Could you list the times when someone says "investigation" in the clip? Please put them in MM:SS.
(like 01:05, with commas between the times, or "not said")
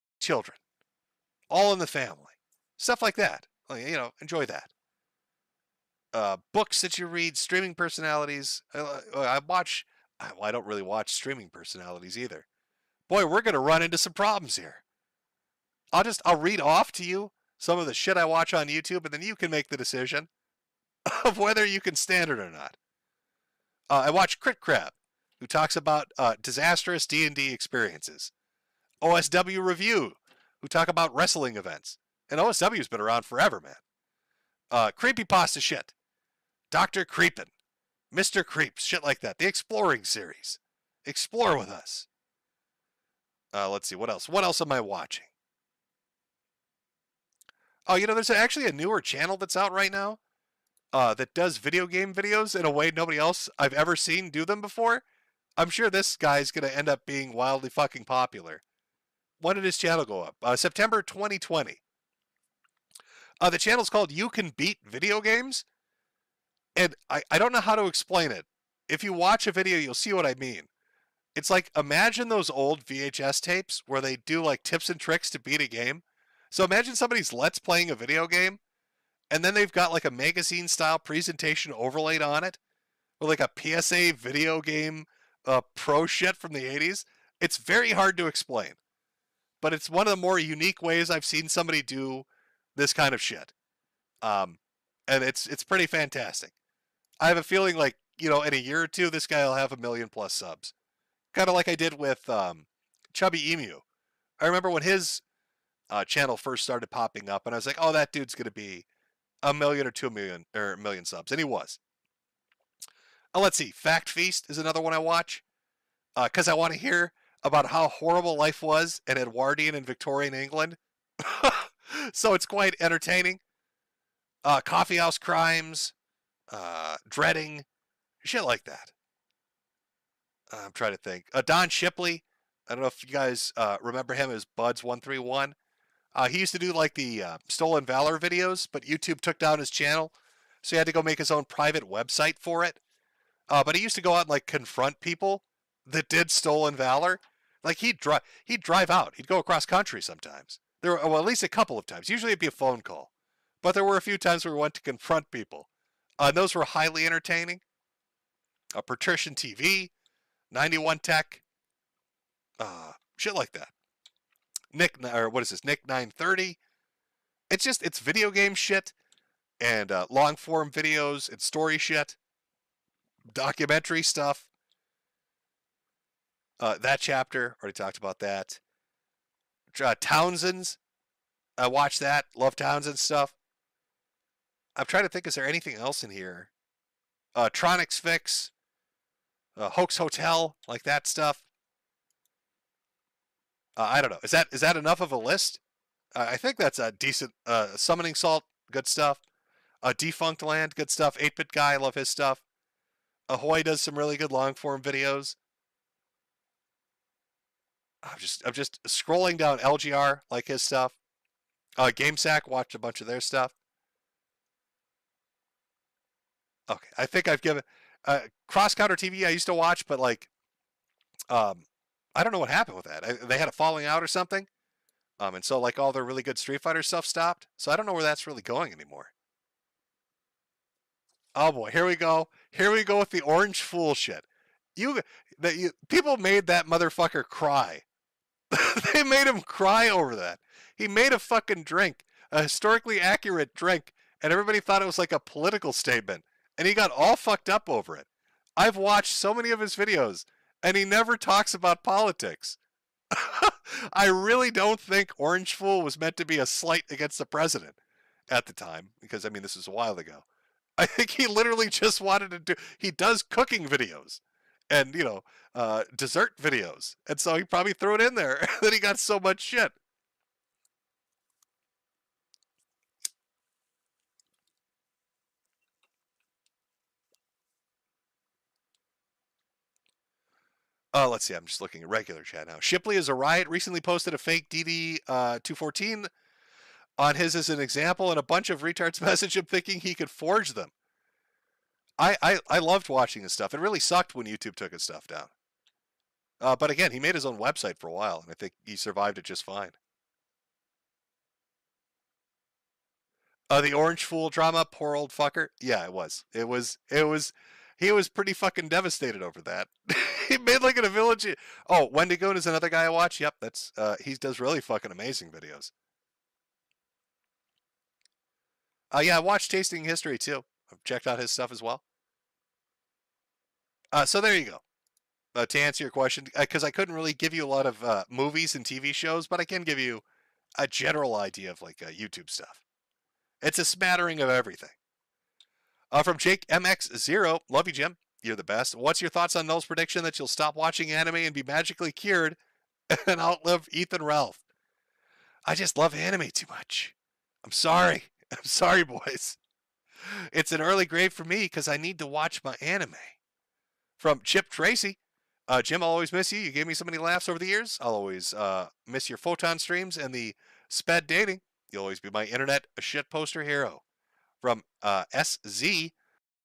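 not said.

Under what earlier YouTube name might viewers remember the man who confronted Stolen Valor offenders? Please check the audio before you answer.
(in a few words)
Buds131.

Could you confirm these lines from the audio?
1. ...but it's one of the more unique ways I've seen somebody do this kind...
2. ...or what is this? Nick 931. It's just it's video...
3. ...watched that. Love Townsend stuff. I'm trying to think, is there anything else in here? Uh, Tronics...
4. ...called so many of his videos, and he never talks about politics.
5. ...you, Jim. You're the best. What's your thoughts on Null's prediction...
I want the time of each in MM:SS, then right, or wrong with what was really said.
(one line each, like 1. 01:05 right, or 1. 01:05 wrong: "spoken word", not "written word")
1. 01:29 right
2. 02:45 wrong: "930", not "931"
3. 03:01 right
4. 04:08 wrong: "watched", not "called"
5. 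05:37 right.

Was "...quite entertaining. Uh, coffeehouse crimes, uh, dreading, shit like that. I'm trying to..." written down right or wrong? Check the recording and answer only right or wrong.
right.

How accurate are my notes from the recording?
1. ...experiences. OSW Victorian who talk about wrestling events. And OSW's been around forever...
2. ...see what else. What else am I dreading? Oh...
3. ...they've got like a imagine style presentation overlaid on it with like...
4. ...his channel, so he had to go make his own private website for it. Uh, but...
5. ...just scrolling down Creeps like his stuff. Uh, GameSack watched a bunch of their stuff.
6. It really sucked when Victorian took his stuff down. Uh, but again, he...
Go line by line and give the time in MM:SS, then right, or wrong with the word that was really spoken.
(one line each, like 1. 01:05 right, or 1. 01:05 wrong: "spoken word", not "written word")
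1. 00:27 wrong: "Review", not "Victorian"
2. 00:43 wrong: "watching", not "dreading"
3. 01:19 wrong: "magazine", not "imagine"
4. 02:19 right
5. 03:28 wrong: "LGR", not "Creeps"
6. 04:53 wrong: "YouTube", not "Victorian".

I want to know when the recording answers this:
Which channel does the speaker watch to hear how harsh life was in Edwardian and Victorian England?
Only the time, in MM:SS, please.
01:53.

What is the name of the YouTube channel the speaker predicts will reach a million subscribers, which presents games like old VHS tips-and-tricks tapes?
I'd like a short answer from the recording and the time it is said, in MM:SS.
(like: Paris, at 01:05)
You Can Beat Video Games, at 01:04.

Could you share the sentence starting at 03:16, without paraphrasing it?
Uh, I think that's a decent uh, summoning salt, good stuff.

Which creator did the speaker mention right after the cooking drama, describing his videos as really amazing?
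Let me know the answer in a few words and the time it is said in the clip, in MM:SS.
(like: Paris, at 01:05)
Wendigoon, at 05:11.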